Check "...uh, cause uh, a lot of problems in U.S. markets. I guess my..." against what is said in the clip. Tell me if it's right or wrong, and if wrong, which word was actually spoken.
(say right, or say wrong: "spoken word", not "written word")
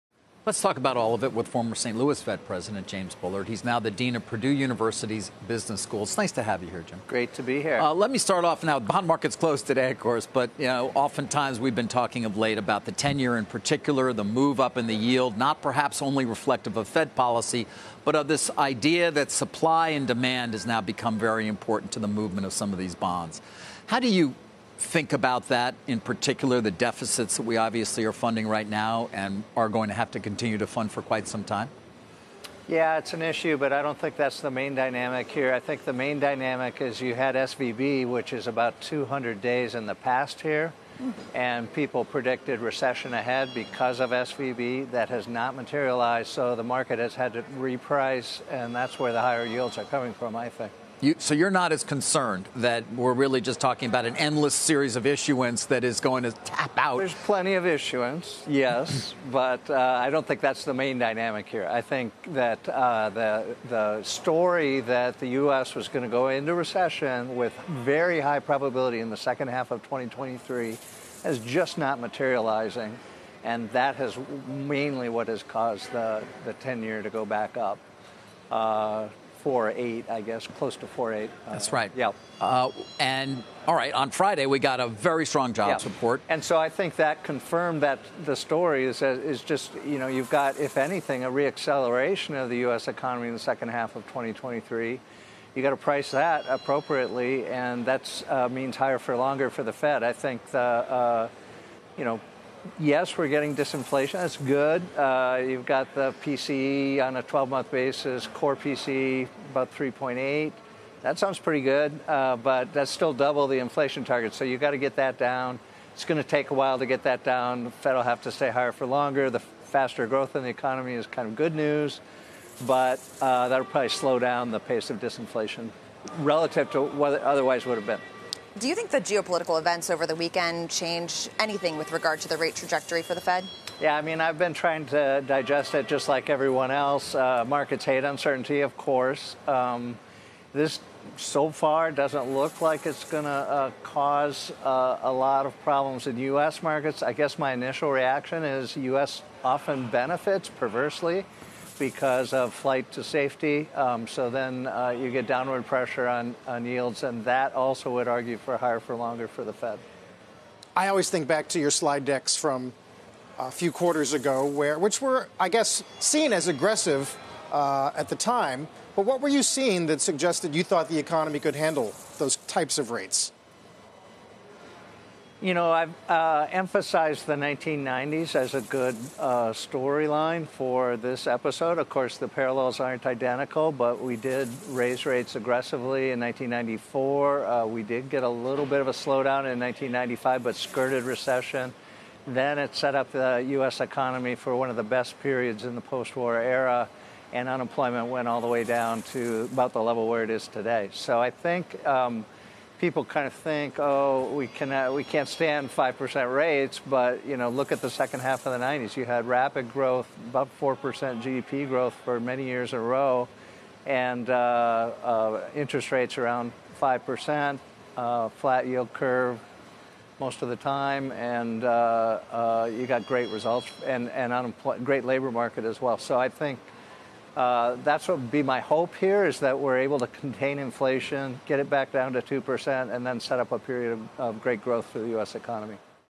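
right.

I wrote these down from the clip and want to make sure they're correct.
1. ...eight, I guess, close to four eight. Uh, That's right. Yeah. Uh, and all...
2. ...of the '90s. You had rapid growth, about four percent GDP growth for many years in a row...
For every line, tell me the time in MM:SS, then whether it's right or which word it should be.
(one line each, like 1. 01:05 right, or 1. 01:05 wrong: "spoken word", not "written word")
1. 01:19 right
2. 03:28 right.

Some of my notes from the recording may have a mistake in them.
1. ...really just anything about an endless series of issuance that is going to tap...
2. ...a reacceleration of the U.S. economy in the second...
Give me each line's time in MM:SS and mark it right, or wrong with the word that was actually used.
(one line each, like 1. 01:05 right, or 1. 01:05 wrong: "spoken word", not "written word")
1. 00:53 wrong: "talking", not "anything"
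2. 01:31 right.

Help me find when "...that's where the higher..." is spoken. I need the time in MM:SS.
00:48.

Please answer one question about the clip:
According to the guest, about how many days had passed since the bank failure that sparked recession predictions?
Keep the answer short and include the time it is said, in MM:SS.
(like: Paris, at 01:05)
200, at 00:38.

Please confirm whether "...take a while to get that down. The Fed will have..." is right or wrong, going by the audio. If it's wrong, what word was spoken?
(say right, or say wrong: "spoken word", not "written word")
right.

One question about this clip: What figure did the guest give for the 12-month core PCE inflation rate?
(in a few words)
3.8.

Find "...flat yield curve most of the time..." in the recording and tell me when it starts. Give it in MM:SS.
03:38.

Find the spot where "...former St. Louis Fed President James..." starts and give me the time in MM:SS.
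00:01.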